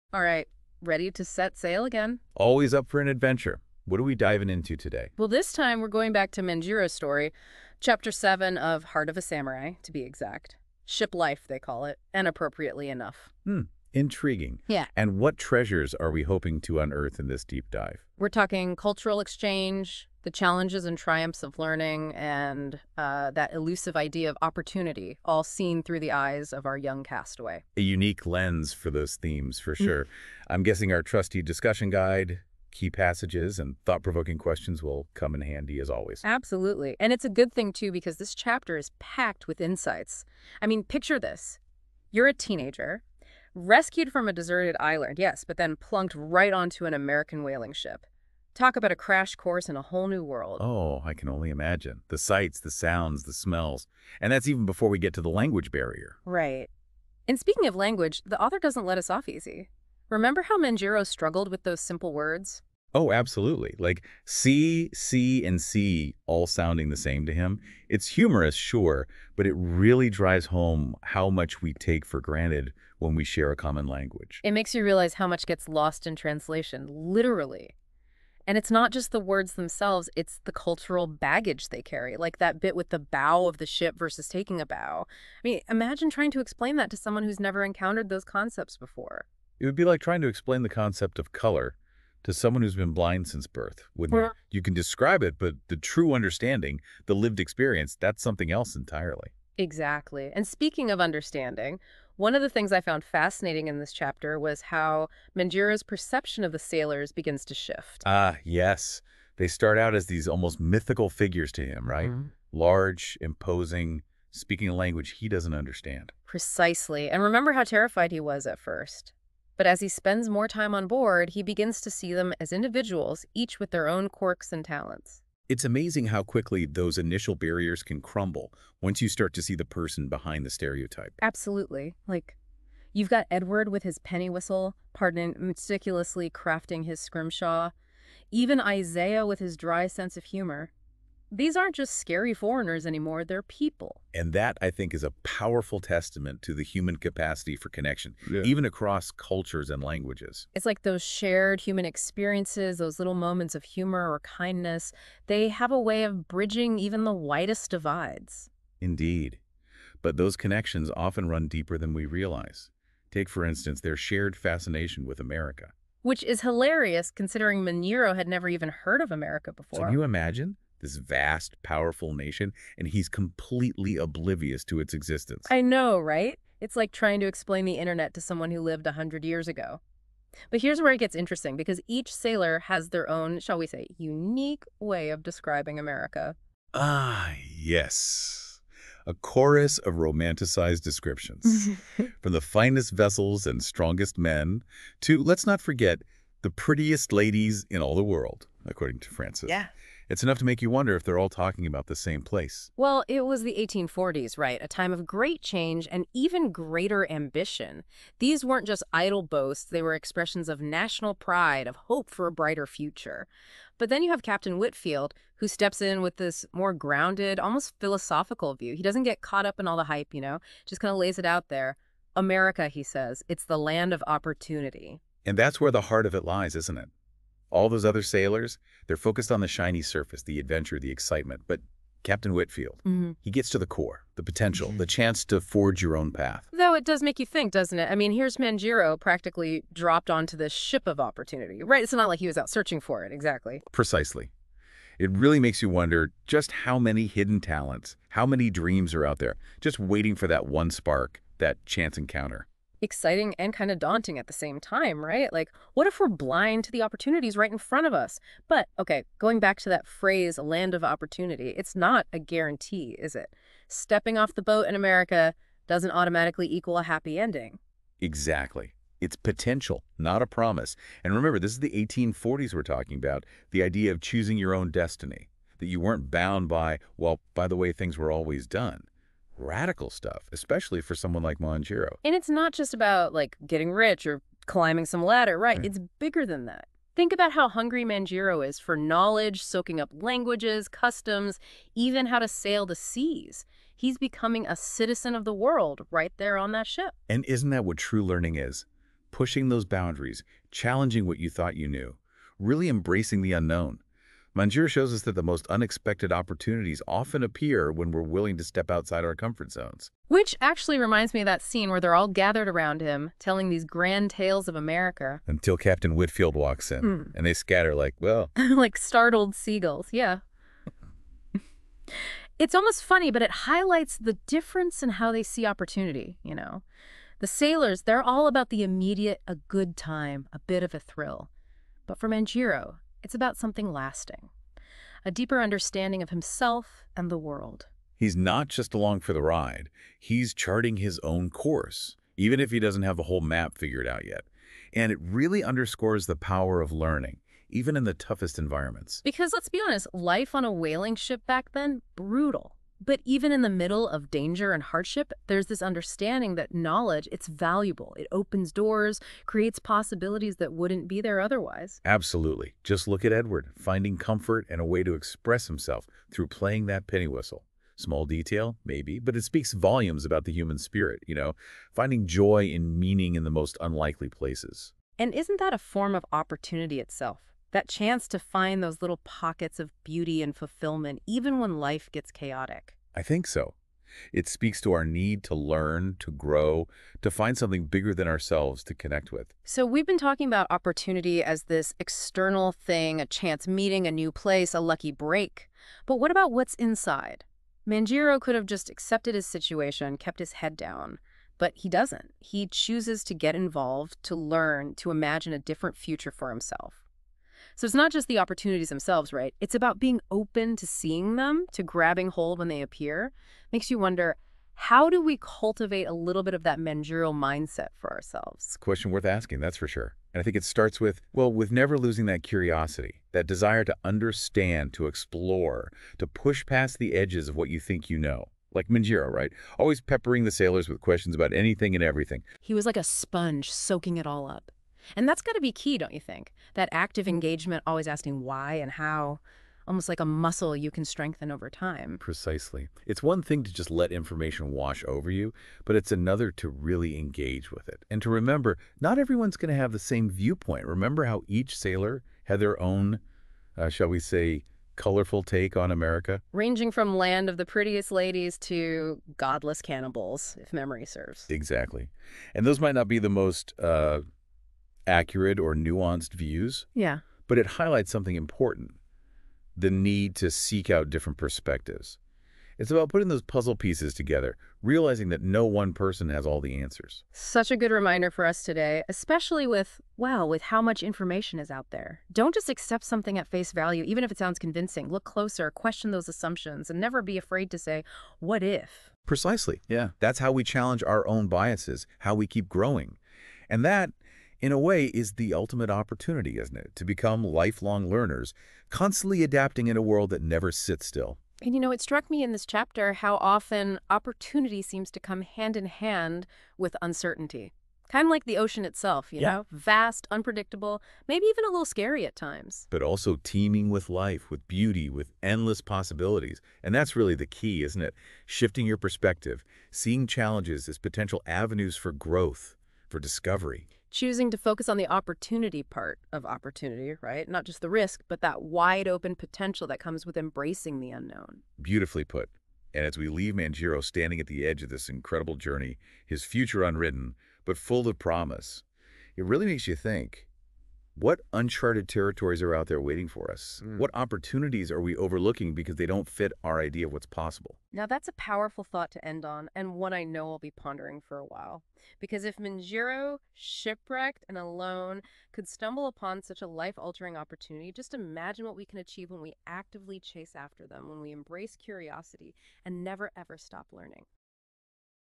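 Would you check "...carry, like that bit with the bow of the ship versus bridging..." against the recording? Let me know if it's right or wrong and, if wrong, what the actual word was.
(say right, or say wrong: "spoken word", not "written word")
wrong: "taking", not "bridging".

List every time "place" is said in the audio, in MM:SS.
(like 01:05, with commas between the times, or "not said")
03:22, 06:14, 06:34.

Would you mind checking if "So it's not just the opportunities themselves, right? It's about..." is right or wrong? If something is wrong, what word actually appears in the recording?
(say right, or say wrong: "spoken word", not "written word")
right.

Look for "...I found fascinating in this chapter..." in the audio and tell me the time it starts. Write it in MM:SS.
01:42.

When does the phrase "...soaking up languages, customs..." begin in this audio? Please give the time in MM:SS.
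04:49.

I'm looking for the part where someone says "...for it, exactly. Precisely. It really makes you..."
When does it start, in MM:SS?
04:02.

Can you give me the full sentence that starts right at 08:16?
To become lifelong learners, constantly adapting in a world that never sits still.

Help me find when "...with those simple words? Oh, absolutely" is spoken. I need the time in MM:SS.
01:01.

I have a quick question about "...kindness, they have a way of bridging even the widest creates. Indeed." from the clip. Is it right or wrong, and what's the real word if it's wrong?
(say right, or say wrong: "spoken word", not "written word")
wrong: "divides", not "creates".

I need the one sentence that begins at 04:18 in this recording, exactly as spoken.
But okay, going back to that phrase, land of opportunity, it's not a guarantee, is it?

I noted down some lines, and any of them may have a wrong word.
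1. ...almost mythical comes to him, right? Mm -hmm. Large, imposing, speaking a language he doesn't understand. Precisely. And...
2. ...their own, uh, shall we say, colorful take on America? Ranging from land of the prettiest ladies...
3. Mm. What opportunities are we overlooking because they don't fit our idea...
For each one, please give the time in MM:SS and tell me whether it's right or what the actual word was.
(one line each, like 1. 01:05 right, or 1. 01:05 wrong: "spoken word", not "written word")
1. 01:50 wrong: "figures", not "comes"
2. 07:32 right
3. 09:03 right.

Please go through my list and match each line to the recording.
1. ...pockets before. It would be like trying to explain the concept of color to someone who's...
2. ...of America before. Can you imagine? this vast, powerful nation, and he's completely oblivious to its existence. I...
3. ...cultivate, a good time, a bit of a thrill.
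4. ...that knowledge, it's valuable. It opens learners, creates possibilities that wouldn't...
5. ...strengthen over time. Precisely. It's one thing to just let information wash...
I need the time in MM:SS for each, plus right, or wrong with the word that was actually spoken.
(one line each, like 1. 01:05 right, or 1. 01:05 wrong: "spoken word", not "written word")
1. 01:28 wrong: "concepts", not "pockets"
2. 02:48 right
3. 05:28 wrong: "immediate", not "cultivate"
4. 05:56 wrong: "doors", not "learners"
5. 07:20 right.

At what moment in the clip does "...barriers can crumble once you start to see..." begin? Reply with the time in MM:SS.
02:07.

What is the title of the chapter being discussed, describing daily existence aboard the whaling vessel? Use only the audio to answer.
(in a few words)
Ship Life.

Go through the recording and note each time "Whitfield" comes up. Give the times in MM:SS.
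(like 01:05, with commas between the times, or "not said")
03:34, 03:52, 05:15.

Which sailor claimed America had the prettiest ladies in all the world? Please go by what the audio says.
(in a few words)
Francis.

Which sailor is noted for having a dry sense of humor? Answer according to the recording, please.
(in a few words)
Isaiah.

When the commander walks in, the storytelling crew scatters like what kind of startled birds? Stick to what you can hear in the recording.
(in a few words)
Seagulls.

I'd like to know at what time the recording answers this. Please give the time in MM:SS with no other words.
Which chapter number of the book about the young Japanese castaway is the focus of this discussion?
00:07.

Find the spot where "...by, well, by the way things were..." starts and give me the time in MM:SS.
04:36.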